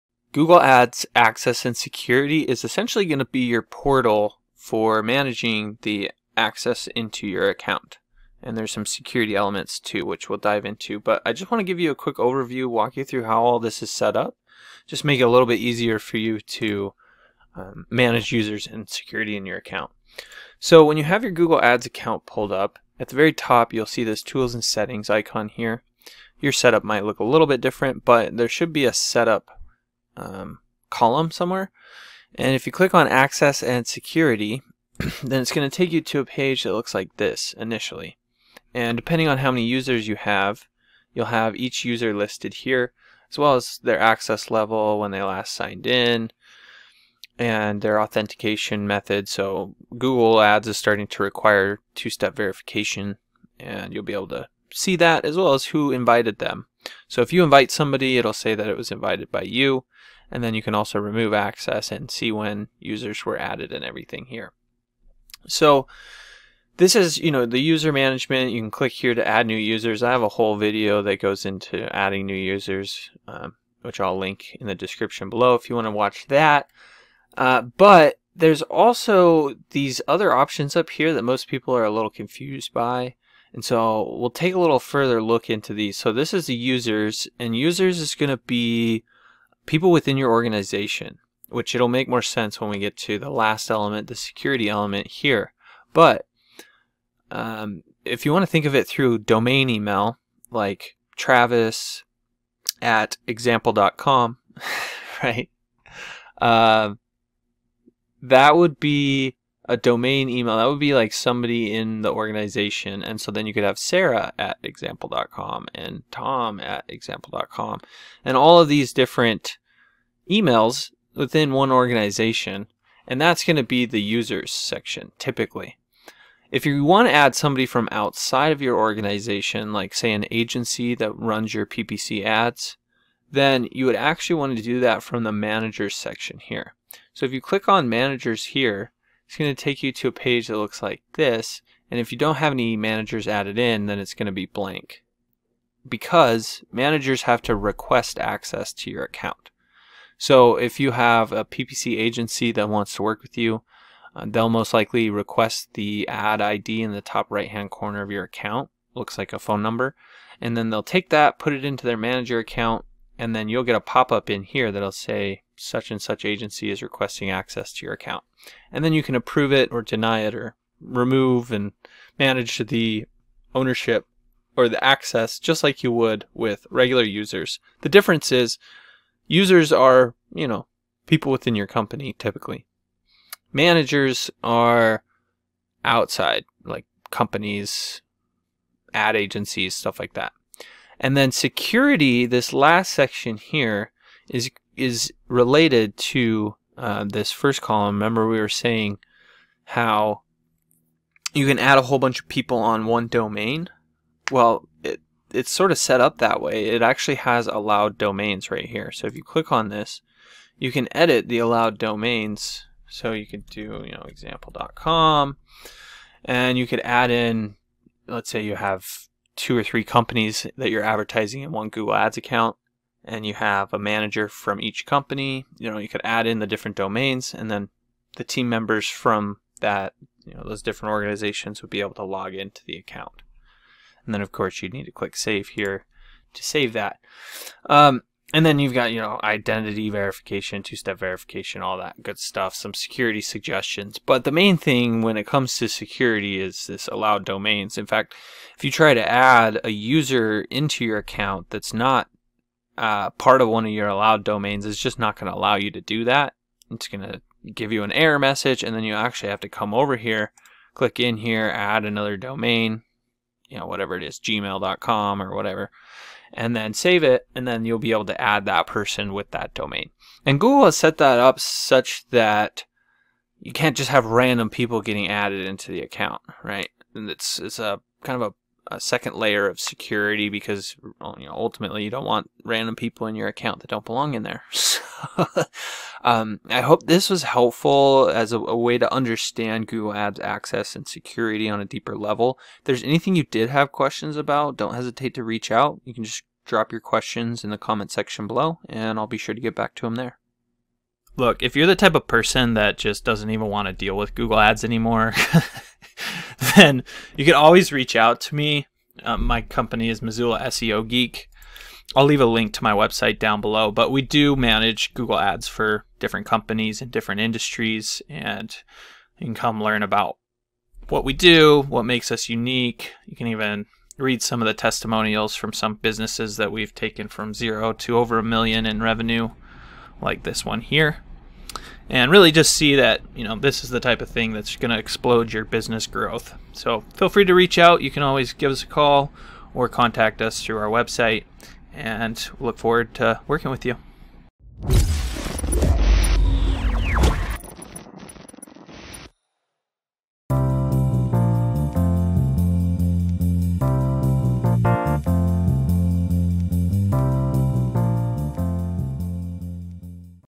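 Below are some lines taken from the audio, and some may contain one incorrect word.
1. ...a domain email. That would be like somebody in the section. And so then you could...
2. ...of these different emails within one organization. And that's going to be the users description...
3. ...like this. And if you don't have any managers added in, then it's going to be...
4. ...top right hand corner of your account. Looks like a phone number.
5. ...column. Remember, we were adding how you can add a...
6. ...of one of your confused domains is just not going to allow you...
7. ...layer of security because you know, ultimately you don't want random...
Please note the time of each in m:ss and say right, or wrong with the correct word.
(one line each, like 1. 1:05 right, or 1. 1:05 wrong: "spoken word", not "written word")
1. 1:49 wrong: "organization", not "section"
2. 1:58 wrong: "section", not "description"
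3. 2:20 right
4. 2:37 right
5. 3:17 wrong: "saying", not "adding"
6. 4:13 wrong: "allowed", not "confused"
7. 4:39 right.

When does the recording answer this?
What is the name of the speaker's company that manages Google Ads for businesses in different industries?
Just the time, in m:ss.
5:10.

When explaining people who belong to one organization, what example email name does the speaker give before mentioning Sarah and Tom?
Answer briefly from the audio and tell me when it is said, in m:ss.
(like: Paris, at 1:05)
travis, at 1:41.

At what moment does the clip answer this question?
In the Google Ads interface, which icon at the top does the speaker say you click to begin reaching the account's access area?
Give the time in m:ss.
0:24.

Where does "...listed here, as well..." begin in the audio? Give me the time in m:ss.
0:42.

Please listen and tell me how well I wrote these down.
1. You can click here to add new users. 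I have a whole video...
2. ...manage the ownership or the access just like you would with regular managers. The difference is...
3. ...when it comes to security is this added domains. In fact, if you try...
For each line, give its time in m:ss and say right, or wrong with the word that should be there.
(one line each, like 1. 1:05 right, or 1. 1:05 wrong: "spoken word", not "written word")
1. 1:08 right
2. 2:52 wrong: "users", not "managers"
3. 4:05 wrong: "allowed", not "added".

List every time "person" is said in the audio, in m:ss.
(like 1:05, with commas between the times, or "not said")
4:28, 5:02.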